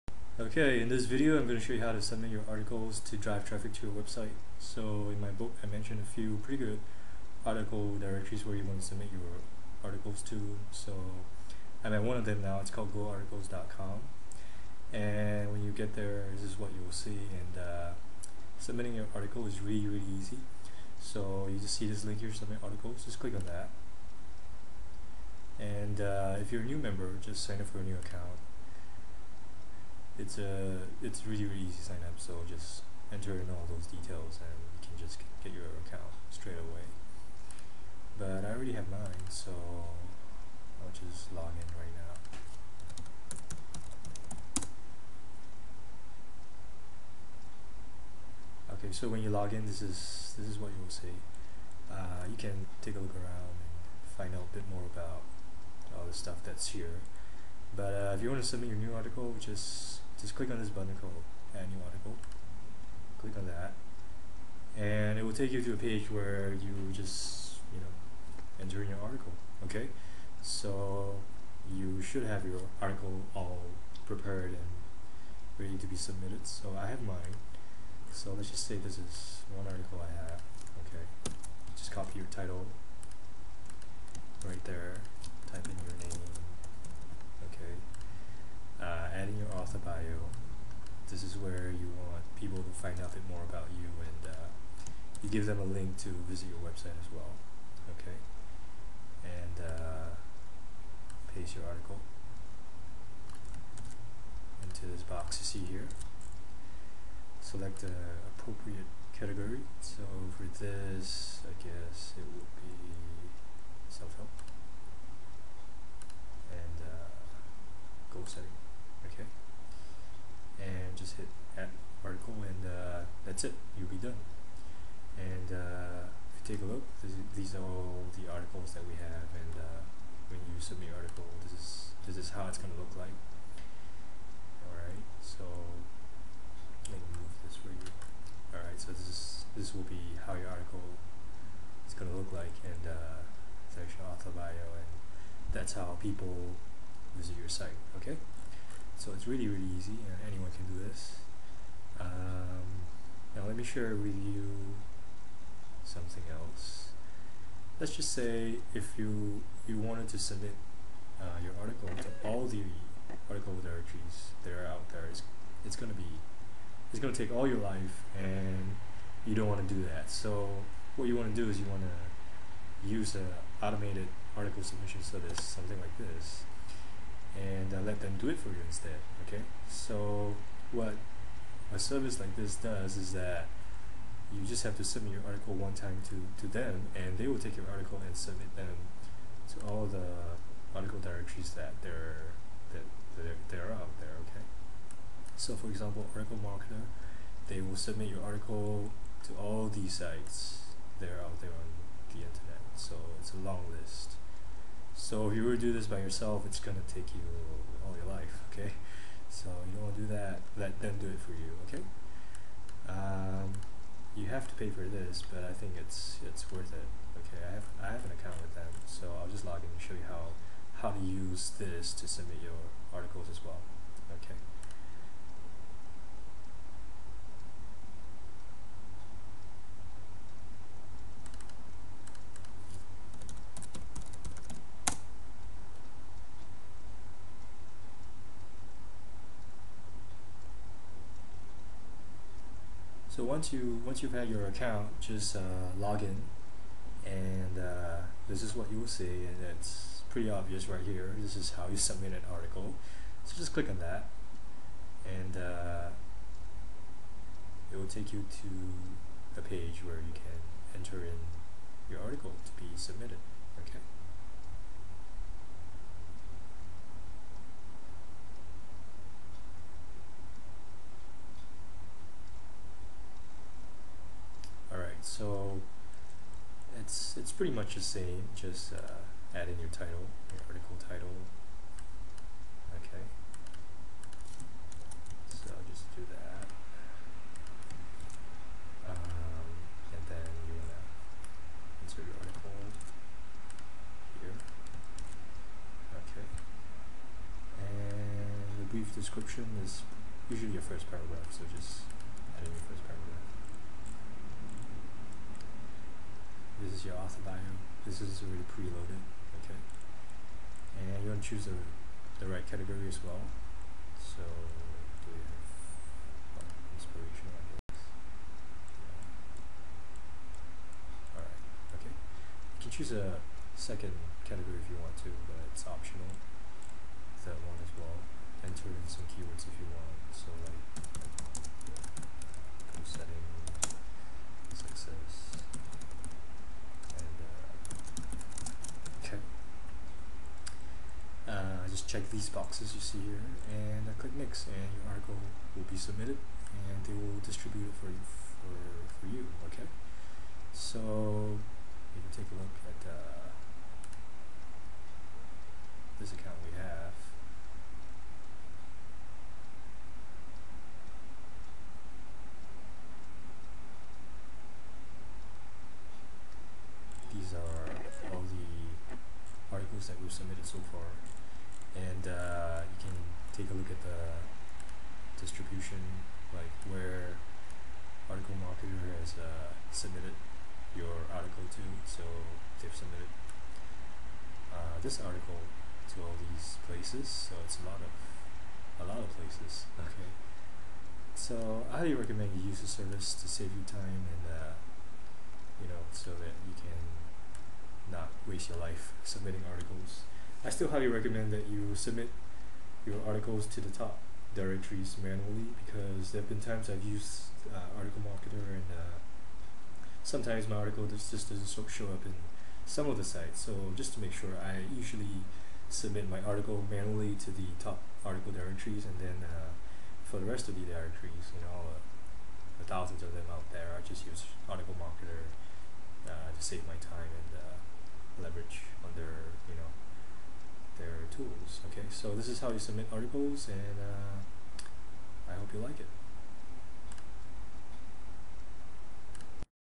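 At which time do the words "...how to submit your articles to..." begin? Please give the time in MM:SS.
00:01.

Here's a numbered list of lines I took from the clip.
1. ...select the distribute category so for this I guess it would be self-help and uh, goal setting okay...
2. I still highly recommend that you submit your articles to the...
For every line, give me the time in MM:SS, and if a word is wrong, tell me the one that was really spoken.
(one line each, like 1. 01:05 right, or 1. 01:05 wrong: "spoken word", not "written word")
1. 01:47 wrong: "appropriate", not "distribute"
2. 06:40 right.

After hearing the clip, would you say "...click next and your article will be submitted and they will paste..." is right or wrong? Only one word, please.
wrong.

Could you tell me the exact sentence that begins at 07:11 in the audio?
Okay, so this is how you submit articles, and uh, I hope you like it.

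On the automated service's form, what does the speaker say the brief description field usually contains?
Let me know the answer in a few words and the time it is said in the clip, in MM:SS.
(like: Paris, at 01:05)
Your first paragraph, at 05:00.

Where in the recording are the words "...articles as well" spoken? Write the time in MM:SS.
03:42.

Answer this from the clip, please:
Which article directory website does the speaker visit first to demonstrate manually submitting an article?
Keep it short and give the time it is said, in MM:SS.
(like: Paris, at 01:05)
goarticles.com, at 00:12.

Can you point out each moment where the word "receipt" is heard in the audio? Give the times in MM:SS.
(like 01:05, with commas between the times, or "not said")
not said.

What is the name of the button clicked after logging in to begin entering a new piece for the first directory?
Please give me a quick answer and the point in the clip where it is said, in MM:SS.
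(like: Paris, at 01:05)
Add New Article, at 01:01.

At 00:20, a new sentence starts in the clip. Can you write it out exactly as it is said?
So you just see this link here, submit articles, just click on that.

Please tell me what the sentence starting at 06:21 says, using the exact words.
So they've submitted uh, this article to all these places.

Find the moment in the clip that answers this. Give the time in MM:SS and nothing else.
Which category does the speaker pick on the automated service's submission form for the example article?
05:16.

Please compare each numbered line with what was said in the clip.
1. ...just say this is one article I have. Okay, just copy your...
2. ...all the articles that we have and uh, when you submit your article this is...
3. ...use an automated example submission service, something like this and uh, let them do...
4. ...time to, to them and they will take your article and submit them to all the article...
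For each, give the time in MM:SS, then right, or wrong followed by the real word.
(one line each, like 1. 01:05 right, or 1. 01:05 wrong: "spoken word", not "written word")
1. 01:18 right
2. 02:07 right
3. 02:52 wrong: "article", not "example"
4. 03:05 right.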